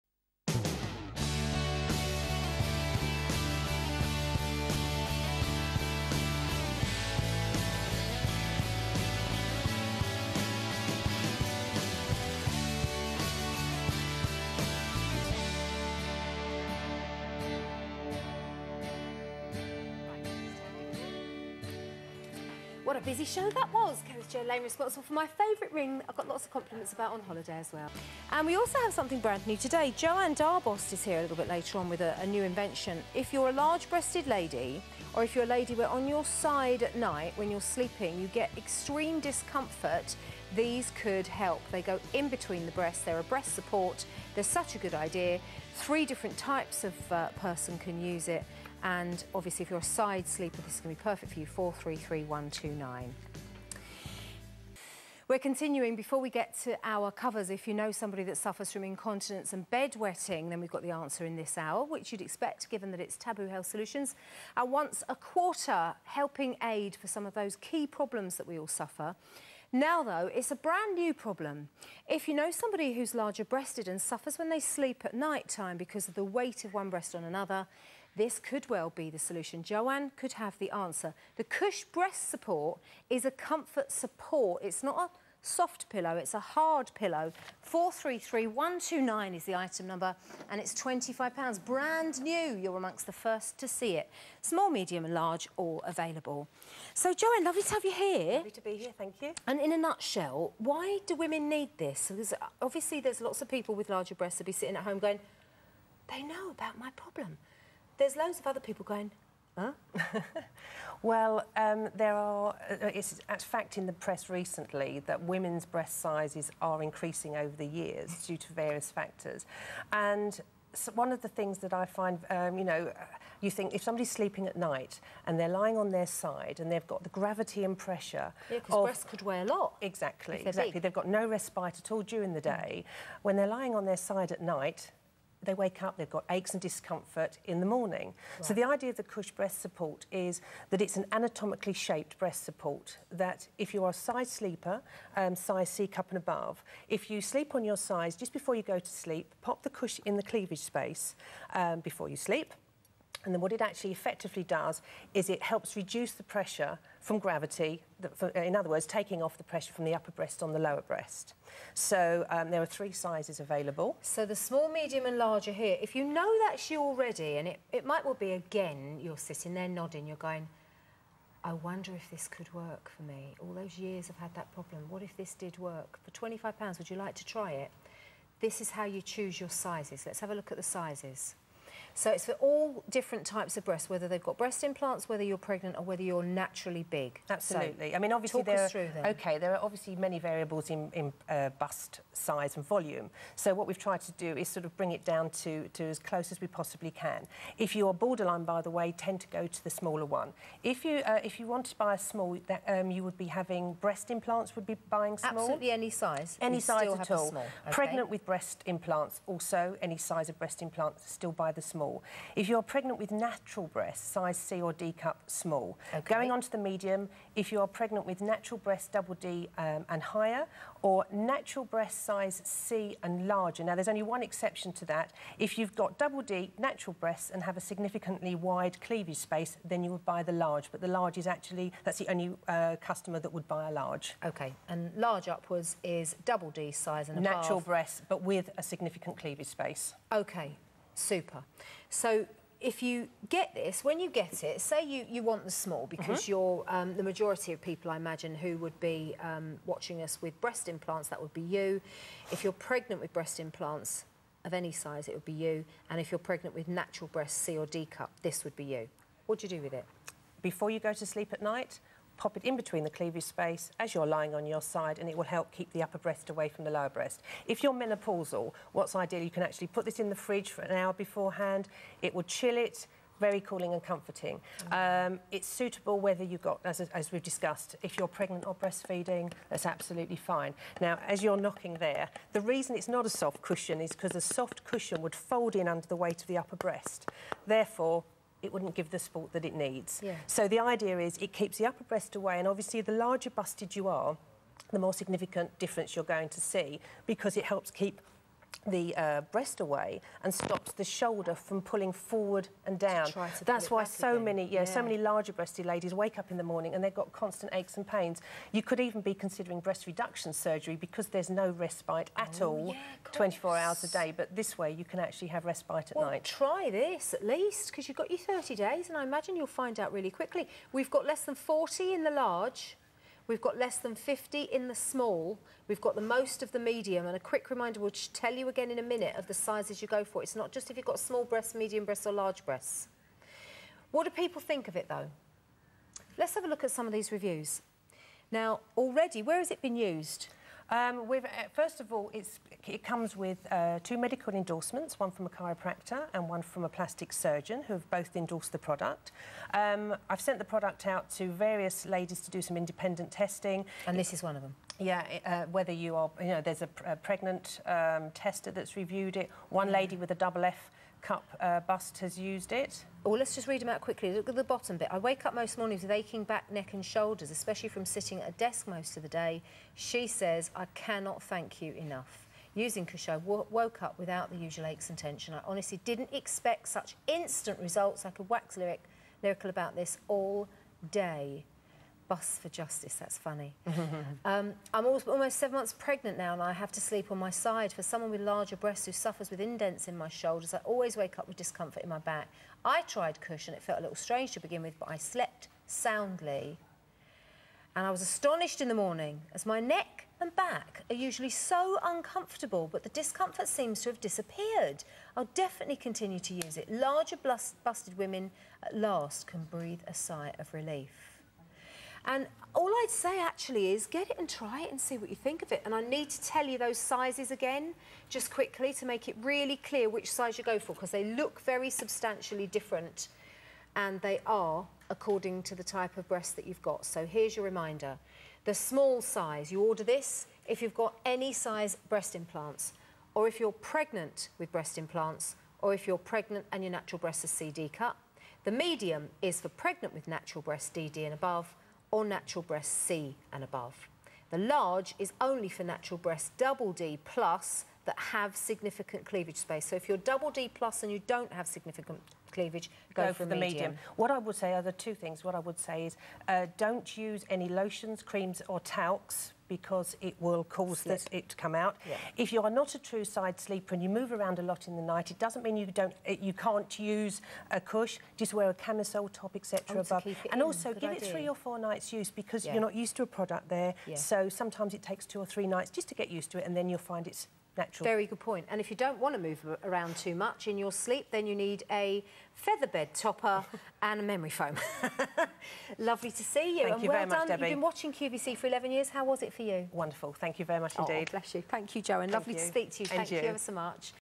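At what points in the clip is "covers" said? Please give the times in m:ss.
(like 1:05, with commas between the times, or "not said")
0:57.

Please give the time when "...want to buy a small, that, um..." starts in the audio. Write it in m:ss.
3:21.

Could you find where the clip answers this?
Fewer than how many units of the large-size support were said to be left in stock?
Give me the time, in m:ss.
5:21.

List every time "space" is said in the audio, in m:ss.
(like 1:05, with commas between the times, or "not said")
2:30, 3:49, 3:59, 4:23, 7:29.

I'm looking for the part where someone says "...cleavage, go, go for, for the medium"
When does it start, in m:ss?
7:32.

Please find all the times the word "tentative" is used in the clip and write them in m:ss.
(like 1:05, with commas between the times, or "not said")
not said.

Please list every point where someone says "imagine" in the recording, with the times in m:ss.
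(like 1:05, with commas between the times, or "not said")
4:07, 5:19.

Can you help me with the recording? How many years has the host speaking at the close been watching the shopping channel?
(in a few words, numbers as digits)
11 years.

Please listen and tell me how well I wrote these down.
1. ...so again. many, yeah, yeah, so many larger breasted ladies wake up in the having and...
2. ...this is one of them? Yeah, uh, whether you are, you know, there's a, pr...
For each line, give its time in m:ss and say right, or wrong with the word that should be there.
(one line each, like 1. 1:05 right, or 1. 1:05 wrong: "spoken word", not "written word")
1. 5:03 wrong: "morning", not "having"
2. 5:53 right.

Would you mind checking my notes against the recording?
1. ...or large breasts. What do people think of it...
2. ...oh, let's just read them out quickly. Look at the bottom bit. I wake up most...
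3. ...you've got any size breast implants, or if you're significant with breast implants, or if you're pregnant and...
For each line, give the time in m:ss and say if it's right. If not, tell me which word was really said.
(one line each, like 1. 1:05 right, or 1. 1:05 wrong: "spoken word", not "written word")
1. 5:32 right
2. 6:03 right
3. 7:10 wrong: "pregnant", not "significant".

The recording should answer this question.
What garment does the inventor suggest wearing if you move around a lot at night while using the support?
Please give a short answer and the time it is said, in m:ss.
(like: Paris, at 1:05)
camisole top, at 7:48.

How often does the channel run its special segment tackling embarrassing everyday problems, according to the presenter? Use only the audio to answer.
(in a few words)
once a quarter.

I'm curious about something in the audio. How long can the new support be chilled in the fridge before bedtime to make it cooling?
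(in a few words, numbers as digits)
an hour.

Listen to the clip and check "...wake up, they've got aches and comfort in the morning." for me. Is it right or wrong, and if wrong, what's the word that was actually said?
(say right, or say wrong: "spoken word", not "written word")
wrong: "discomfort", not "comfort".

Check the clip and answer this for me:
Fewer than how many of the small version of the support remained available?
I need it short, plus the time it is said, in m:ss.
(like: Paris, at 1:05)
50, at 5:23.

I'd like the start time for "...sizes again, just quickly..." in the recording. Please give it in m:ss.
6:56.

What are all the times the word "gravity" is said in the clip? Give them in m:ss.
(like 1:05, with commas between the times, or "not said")
2:07, 2:37.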